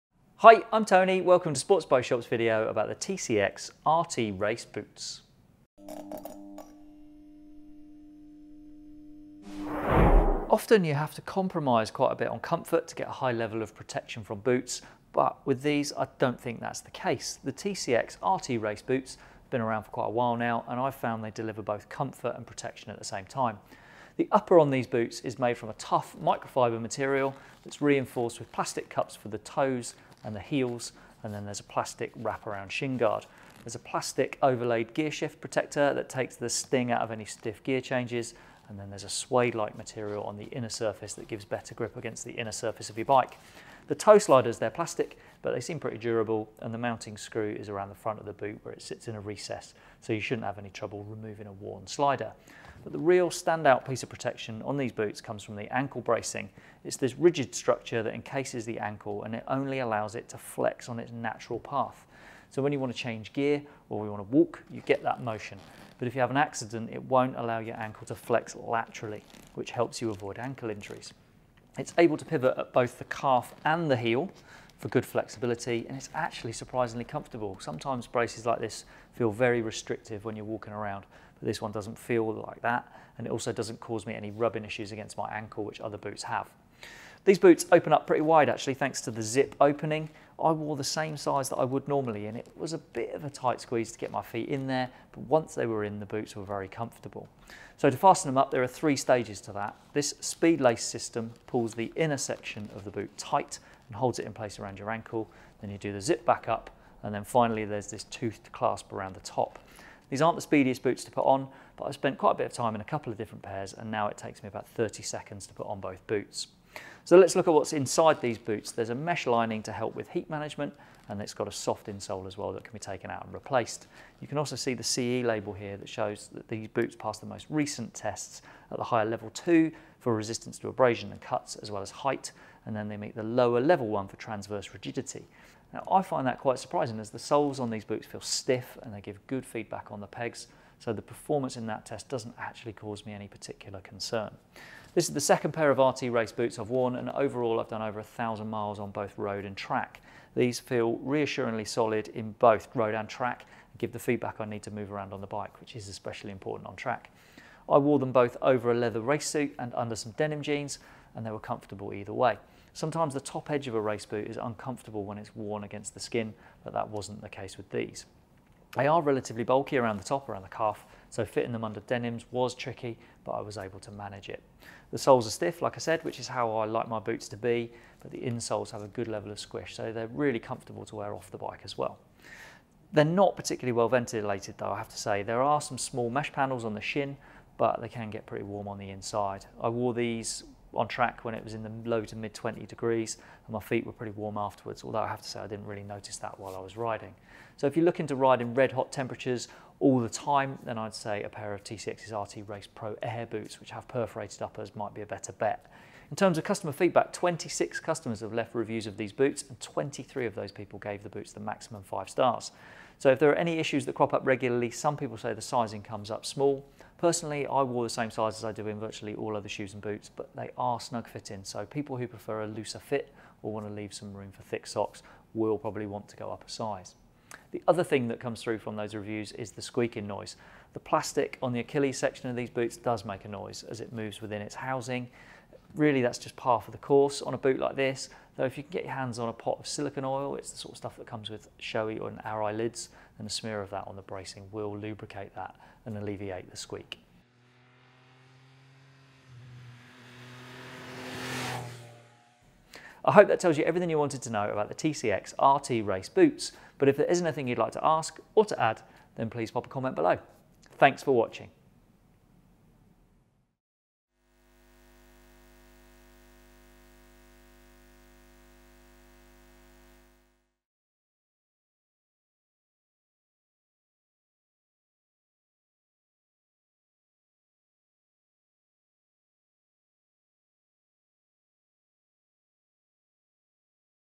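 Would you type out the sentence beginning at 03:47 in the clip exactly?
The other thing that comes through from those reviews is the squeaking noise.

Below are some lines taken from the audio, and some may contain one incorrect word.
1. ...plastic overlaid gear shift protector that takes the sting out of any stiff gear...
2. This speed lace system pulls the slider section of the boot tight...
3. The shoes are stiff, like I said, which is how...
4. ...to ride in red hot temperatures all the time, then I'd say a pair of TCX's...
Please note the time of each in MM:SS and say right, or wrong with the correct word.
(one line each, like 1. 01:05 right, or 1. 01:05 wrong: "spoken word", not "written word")
1. 00:33 right
2. 01:39 wrong: "inner", not "slider"
3. 02:54 wrong: "soles", not "shoes"
4. 03:18 right.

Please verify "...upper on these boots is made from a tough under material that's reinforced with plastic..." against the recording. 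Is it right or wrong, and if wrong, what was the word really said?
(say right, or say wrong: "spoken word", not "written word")
wrong: "microfiber", not "under".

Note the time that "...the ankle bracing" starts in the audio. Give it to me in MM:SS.
00:55.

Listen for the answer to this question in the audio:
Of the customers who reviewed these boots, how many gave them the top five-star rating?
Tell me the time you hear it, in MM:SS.
03:29.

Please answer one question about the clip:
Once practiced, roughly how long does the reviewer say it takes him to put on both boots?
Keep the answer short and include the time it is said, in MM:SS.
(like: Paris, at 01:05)
30 seconds, at 01:54.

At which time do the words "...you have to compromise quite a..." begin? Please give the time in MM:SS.
00:10.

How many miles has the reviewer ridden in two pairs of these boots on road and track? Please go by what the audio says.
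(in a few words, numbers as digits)
1000.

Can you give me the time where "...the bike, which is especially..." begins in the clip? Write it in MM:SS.
02:35.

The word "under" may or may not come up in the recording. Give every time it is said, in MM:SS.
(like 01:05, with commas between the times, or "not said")
02:39, 02:51.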